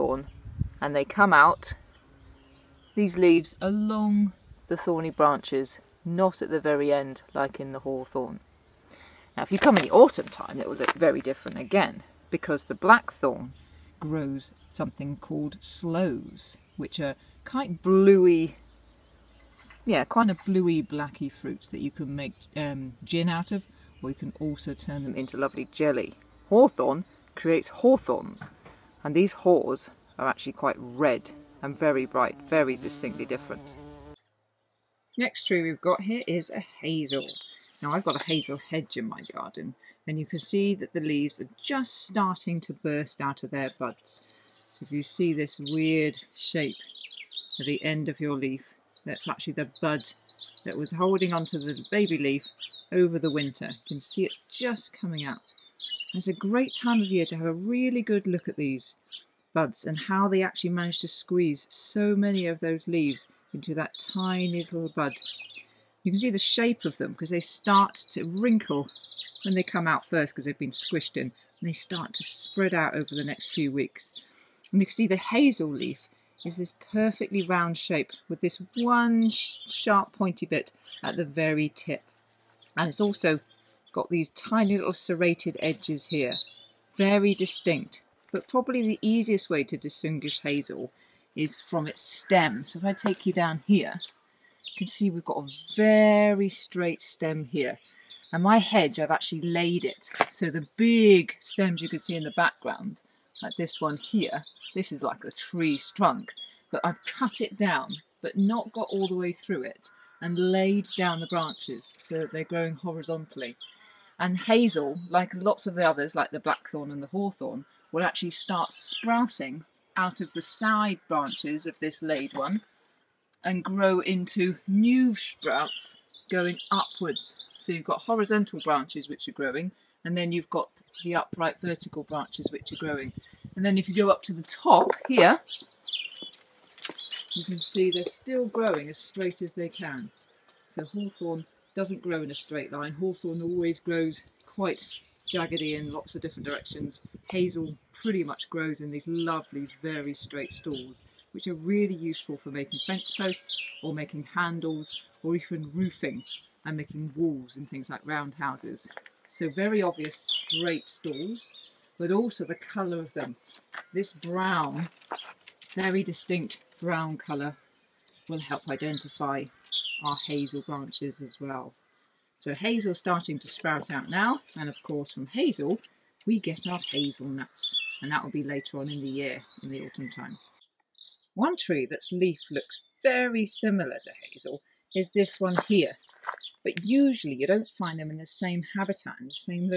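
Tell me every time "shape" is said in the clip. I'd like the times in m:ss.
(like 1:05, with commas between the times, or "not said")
0:46, 1:06, 1:17.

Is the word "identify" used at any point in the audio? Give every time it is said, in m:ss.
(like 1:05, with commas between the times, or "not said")
2:48.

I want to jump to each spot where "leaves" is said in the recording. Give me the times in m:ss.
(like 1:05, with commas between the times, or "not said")
0:03, 0:40, 1:02.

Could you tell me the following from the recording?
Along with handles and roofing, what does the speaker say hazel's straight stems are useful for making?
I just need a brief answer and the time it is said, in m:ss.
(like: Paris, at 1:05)
Fence posts, at 2:32.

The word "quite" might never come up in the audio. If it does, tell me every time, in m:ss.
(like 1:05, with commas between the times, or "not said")
0:17, 0:30, 2:24.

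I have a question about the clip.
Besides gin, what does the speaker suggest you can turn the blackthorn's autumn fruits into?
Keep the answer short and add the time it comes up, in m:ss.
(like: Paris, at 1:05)
Jelly, at 0:25.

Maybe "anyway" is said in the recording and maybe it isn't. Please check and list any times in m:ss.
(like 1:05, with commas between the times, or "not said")
not said.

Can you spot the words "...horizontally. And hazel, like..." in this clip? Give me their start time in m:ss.
1:52.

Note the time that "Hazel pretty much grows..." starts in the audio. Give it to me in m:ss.
2:27.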